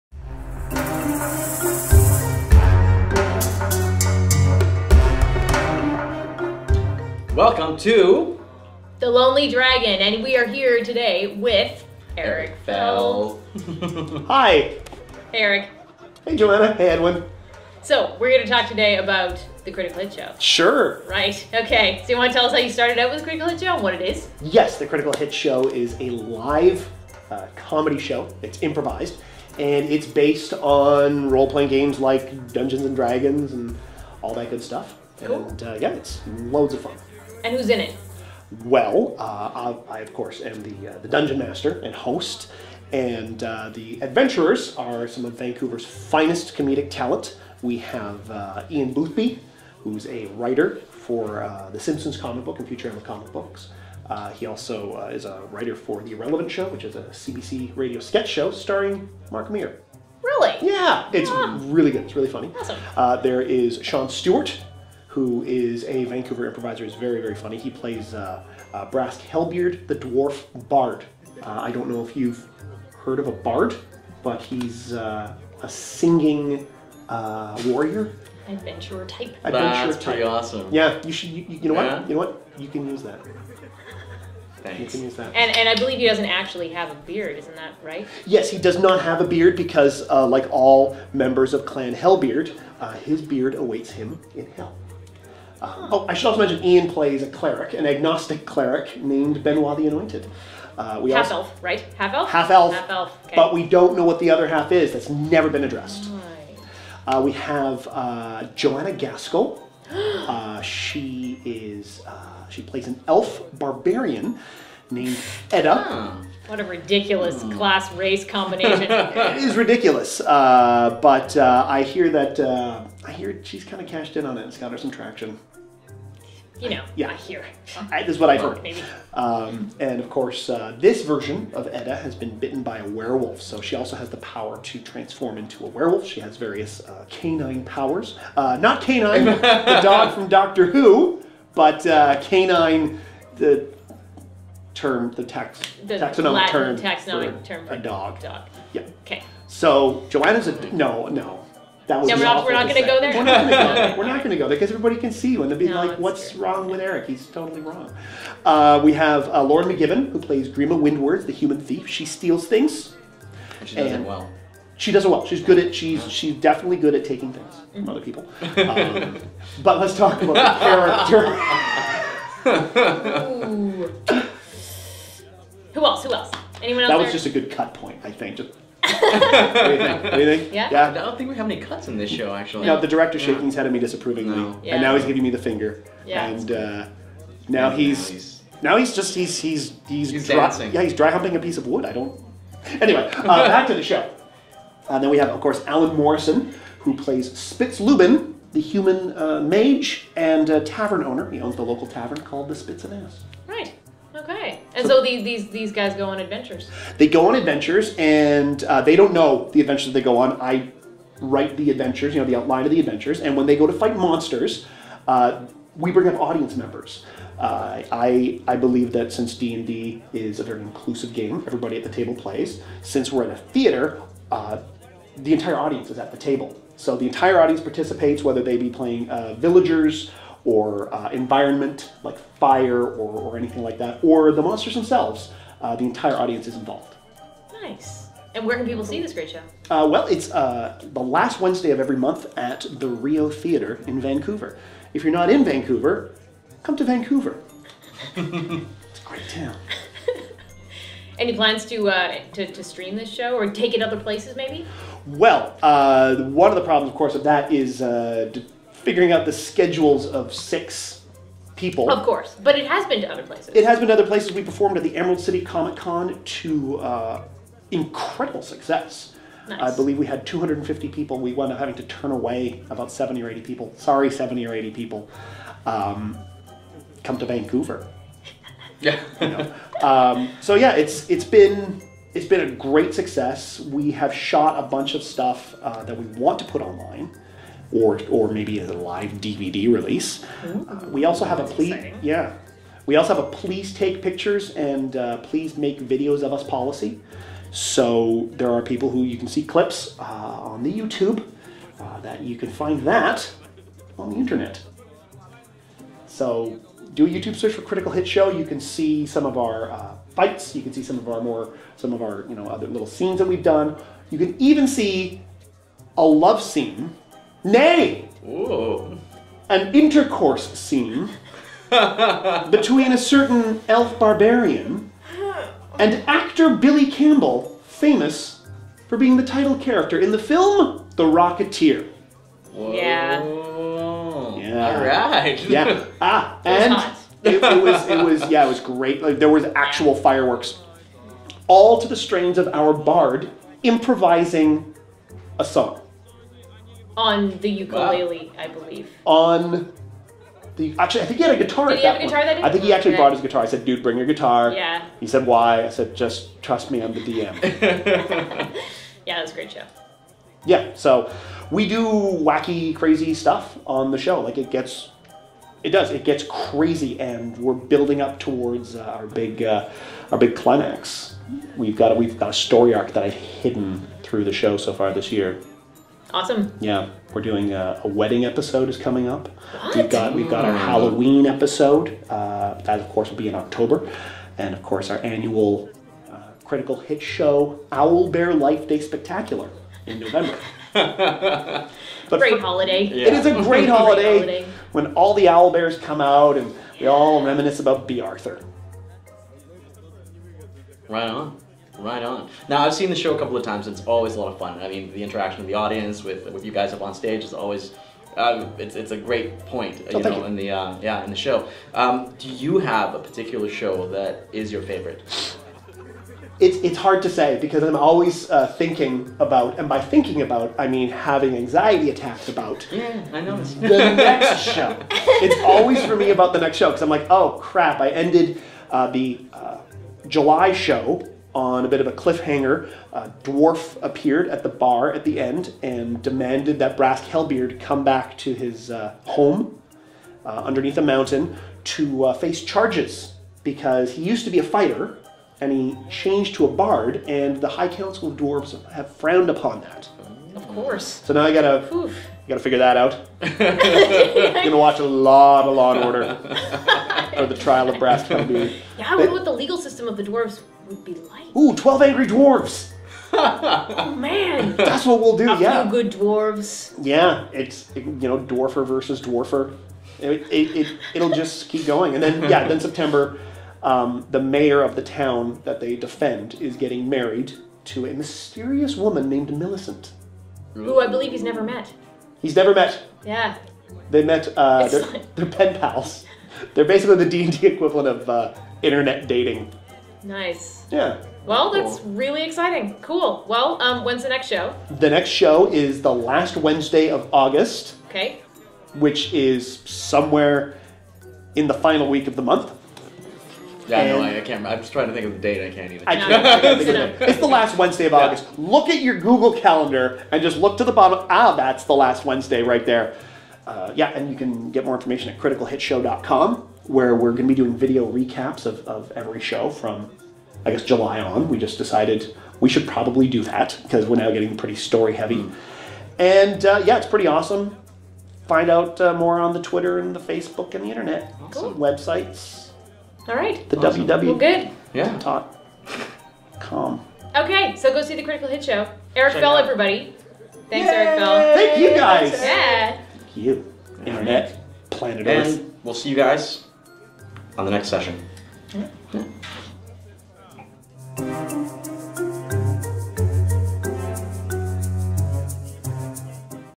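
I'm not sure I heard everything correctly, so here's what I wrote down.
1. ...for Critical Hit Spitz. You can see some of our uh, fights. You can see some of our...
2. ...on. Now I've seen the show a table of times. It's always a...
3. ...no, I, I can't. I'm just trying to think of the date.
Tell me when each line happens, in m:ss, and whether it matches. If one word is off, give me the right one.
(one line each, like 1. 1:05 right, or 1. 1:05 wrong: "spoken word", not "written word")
1. 5:07 wrong: "Show", not "Spitz"
2. 6:42 wrong: "couple", not "table"
3. 8:23 right.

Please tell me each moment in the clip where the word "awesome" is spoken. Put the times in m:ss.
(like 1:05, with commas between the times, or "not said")
1:02, 1:20, 6:16, 8:47, 8:53.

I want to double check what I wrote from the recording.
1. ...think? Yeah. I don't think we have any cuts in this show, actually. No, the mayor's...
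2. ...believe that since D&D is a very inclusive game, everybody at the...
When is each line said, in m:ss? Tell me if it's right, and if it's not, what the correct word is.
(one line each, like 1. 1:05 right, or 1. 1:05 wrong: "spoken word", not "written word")
1. 3:00 wrong: "director", not "mayor"
2. 3:38 right.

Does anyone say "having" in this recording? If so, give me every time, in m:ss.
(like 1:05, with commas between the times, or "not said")
4:31, 7:00.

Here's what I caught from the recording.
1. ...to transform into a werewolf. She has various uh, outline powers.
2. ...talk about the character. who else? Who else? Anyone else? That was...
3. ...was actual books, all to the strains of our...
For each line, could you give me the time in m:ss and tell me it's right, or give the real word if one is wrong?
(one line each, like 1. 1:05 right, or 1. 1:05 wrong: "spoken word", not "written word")
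1. 2:14 wrong: "canine", not "outline"
2. 2:49 right
3. 5:39 wrong: "fireworks", not "books".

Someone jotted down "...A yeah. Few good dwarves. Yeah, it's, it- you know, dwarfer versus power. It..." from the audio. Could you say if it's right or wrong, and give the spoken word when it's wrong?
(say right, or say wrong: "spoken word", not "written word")
wrong: "dwarfer", not "power".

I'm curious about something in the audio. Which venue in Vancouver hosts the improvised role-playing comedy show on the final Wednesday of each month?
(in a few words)
Rio Theater.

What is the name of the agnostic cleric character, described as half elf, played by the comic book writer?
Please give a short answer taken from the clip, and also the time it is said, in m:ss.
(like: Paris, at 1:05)
Benoit the Anointed, at 1:39.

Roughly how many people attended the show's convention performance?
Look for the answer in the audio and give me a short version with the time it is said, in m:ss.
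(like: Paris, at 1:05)
250, at 4:30.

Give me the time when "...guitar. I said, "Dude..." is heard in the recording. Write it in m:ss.
5:53.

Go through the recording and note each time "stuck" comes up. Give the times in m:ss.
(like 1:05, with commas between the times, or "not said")
not said.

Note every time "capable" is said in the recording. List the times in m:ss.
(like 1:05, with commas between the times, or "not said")
not said.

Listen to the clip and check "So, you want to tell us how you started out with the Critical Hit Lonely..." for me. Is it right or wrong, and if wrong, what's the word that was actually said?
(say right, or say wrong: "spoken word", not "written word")
wrong: "Show", not "Lonely".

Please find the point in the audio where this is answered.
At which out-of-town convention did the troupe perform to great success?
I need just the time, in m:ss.
4:24.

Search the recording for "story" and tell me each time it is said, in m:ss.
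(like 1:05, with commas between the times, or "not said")
6:12, 8:44.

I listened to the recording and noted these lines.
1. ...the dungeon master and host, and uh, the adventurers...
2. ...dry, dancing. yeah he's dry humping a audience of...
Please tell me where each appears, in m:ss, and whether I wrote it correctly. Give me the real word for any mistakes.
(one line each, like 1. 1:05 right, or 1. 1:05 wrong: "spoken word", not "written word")
1. 0:40 right
2. 3:10 wrong: "piece", not "audience".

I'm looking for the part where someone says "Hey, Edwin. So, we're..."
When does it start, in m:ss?
0:16.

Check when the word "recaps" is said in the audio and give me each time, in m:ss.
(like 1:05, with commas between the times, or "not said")
8:37.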